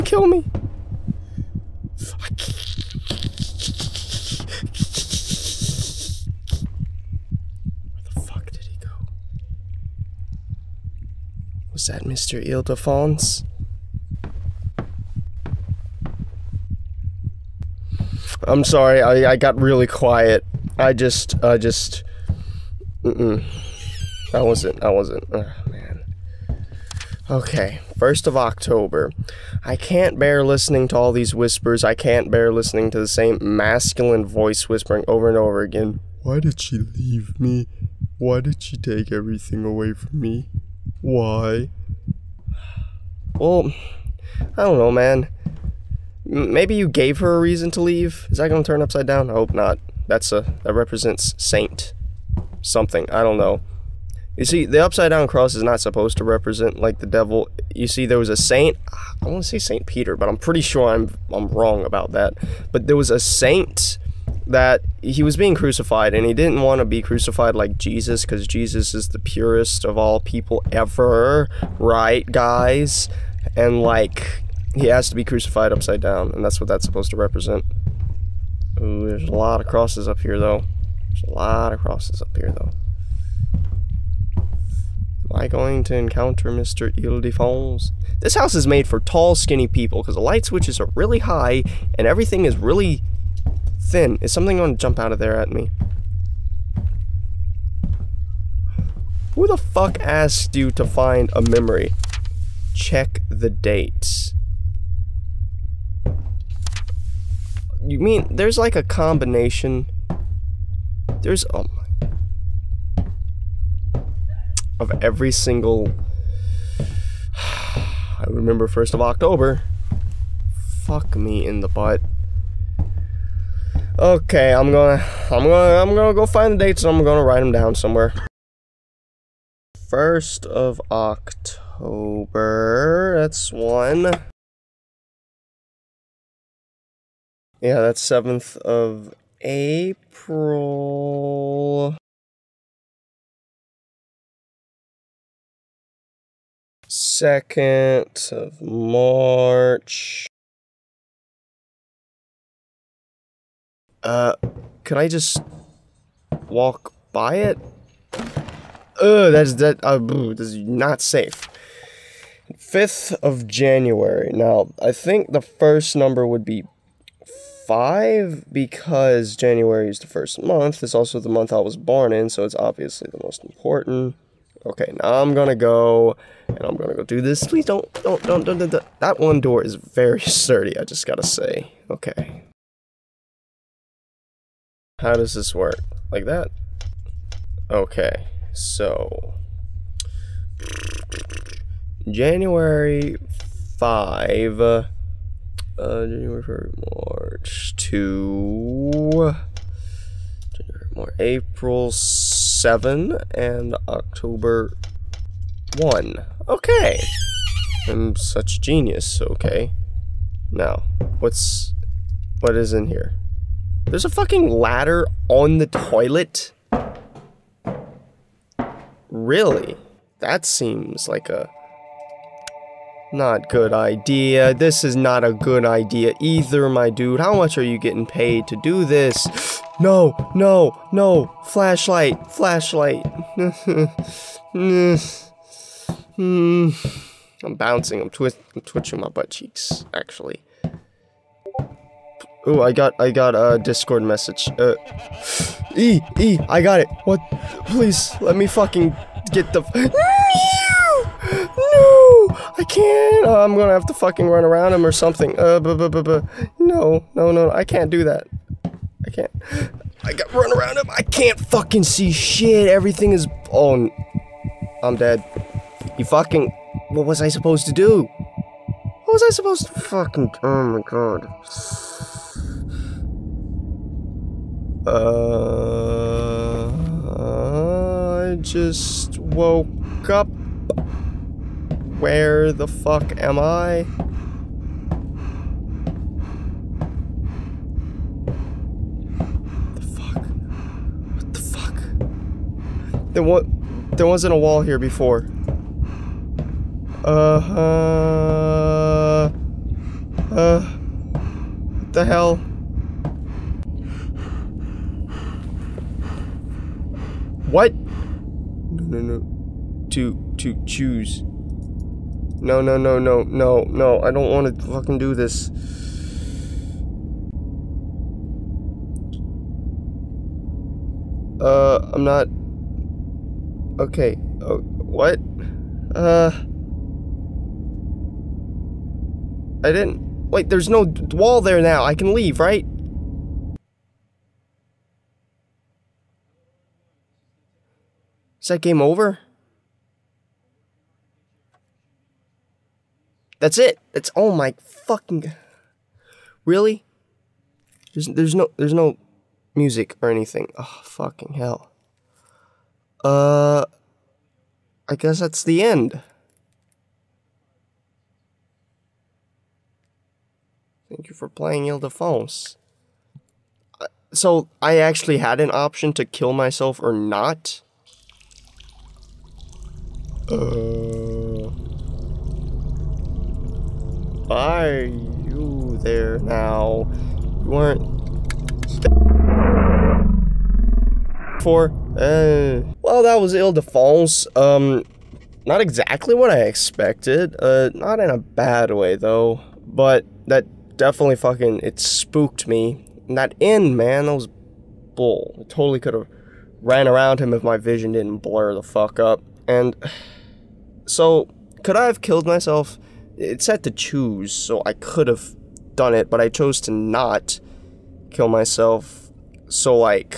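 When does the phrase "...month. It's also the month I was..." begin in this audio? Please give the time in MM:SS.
02:50.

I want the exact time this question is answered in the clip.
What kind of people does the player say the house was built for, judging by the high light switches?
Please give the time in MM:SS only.
01:28.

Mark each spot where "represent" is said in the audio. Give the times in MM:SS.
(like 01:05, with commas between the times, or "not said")
00:50, 00:56, 01:17.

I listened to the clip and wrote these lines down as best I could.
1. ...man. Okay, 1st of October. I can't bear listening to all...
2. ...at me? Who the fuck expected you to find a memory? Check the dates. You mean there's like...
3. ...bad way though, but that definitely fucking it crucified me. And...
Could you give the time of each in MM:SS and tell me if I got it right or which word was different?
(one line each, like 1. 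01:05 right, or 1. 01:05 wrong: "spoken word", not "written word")
1. 00:25 right
2. 01:35 wrong: "asked", not "expected"
3. 06:28 wrong: "spooked", not "crucified".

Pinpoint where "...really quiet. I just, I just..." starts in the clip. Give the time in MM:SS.
00:19.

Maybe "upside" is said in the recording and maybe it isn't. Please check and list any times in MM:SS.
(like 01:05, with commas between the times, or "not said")
00:48, 00:54, 01:15.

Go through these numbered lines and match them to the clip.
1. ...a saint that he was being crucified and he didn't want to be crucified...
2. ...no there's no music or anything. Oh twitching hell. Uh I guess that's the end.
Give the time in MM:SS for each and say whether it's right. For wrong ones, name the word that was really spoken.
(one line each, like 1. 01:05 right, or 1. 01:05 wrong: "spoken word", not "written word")
1. 01:03 right
2. 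05:48 wrong: "fucking", not "twitching".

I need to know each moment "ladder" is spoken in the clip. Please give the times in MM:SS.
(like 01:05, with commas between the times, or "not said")
03:34.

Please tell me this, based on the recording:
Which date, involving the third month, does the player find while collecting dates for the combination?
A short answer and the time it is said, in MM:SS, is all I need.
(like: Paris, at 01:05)
2nd of March, at 02:26.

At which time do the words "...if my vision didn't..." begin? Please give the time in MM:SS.
06:37.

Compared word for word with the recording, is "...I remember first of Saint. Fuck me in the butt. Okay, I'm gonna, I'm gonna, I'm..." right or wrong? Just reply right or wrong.
wrong.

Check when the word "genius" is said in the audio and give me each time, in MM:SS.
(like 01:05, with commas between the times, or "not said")
03:28.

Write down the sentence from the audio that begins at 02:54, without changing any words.
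Okay, now I'm gonna go and I'm gonna go do this.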